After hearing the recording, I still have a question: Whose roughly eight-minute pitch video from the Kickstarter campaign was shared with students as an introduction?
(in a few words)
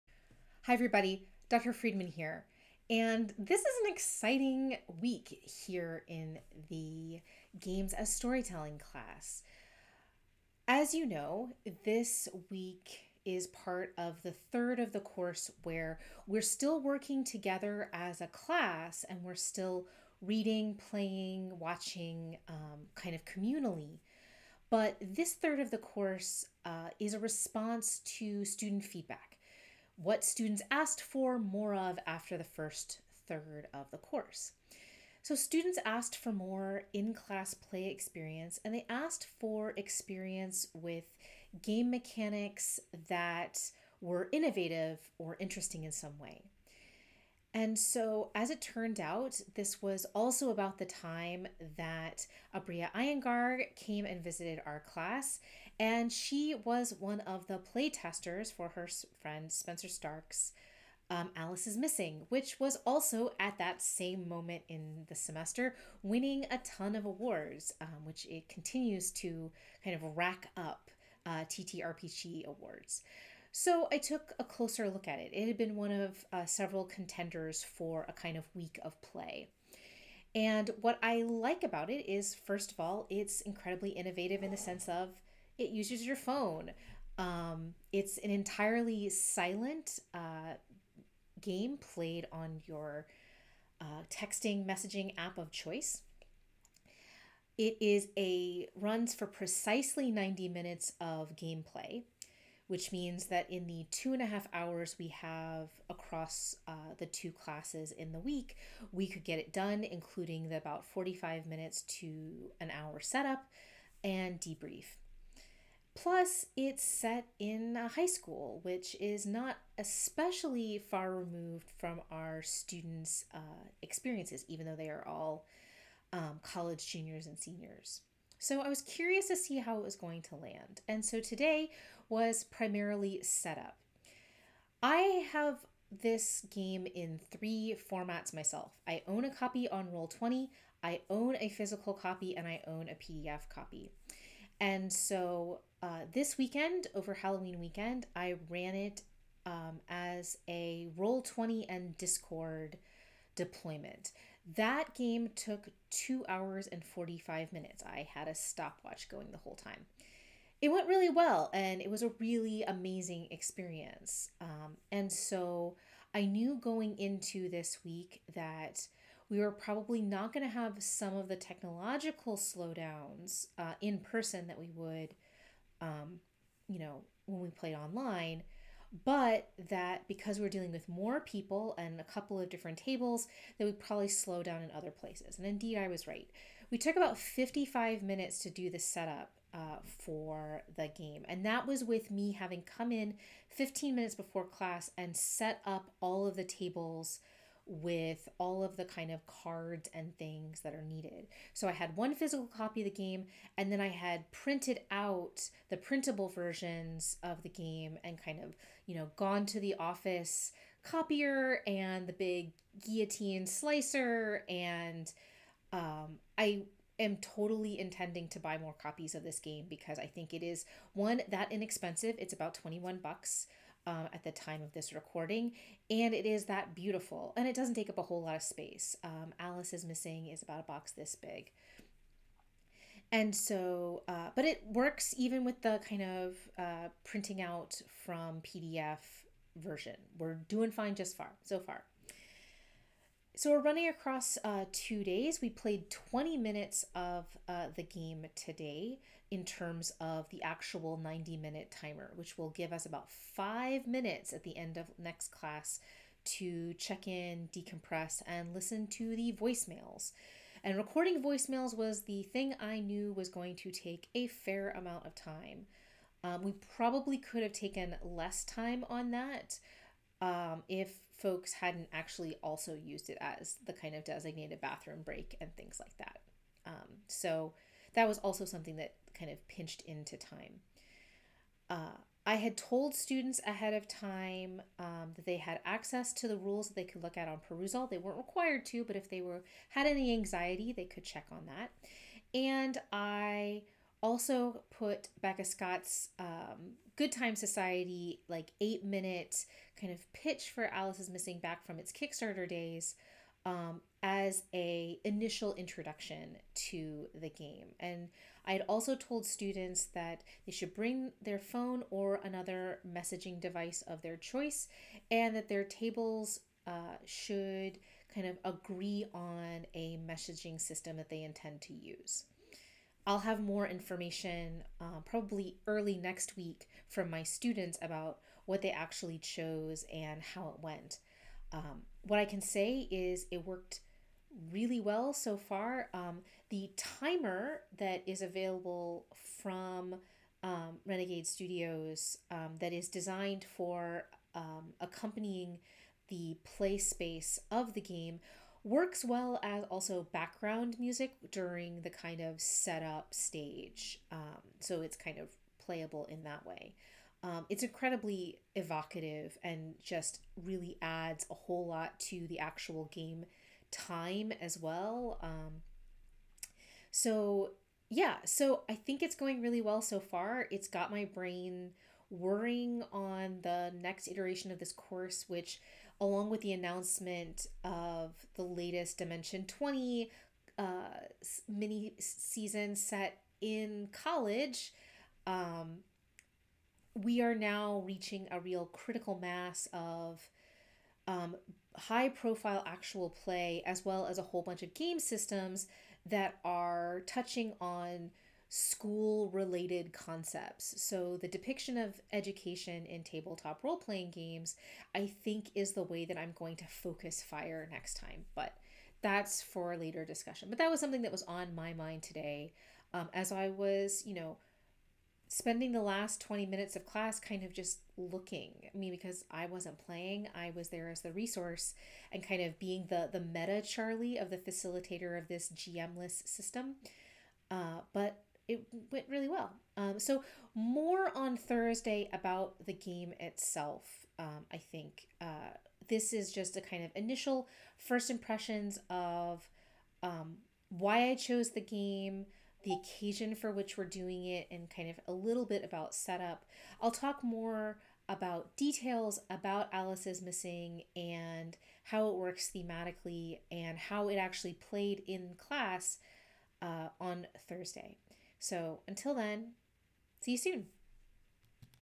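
Becca Scott.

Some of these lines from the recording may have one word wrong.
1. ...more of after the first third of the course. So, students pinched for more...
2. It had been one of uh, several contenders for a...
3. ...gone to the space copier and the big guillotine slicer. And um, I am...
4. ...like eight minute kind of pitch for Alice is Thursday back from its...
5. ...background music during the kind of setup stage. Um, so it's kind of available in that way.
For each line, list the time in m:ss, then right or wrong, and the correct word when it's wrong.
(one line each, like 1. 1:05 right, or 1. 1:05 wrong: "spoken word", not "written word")
1. 0:31 wrong: "asked", not "pinched"
2. 1:15 right
3. 3:29 wrong: "office", not "space"
4. 4:58 wrong: "Missing", not "Thursday"
5. 5:50 wrong: "playable", not "available".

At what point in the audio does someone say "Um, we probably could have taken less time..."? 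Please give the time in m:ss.
4:26.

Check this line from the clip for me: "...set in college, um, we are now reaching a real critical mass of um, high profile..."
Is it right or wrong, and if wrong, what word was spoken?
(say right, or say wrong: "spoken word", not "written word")
right.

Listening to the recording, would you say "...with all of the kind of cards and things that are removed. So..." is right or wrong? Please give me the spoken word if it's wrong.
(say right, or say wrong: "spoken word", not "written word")
wrong: "needed", not "removed".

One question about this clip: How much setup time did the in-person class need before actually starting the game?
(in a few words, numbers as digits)
55 minutes.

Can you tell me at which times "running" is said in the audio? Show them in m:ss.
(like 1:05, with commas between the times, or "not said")
4:03.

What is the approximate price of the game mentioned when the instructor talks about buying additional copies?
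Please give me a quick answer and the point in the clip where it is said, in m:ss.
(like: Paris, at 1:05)
21 dollars, at 3:42.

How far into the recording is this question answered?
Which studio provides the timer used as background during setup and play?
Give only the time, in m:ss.
5:40.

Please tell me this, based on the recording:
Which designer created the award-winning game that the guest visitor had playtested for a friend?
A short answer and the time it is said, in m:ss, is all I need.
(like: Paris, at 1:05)
Spenser Starke, at 0:59.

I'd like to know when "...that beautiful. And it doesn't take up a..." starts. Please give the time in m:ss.
3:46.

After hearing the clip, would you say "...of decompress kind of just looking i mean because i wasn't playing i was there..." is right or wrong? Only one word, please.
wrong.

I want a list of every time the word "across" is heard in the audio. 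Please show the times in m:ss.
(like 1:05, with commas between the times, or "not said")
1:45, 4:03.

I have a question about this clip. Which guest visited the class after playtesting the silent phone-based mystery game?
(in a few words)
Aabria Iyengar.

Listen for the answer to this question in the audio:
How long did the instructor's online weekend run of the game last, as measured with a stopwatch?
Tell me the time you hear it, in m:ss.
2:35.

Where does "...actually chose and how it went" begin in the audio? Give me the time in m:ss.
5:28.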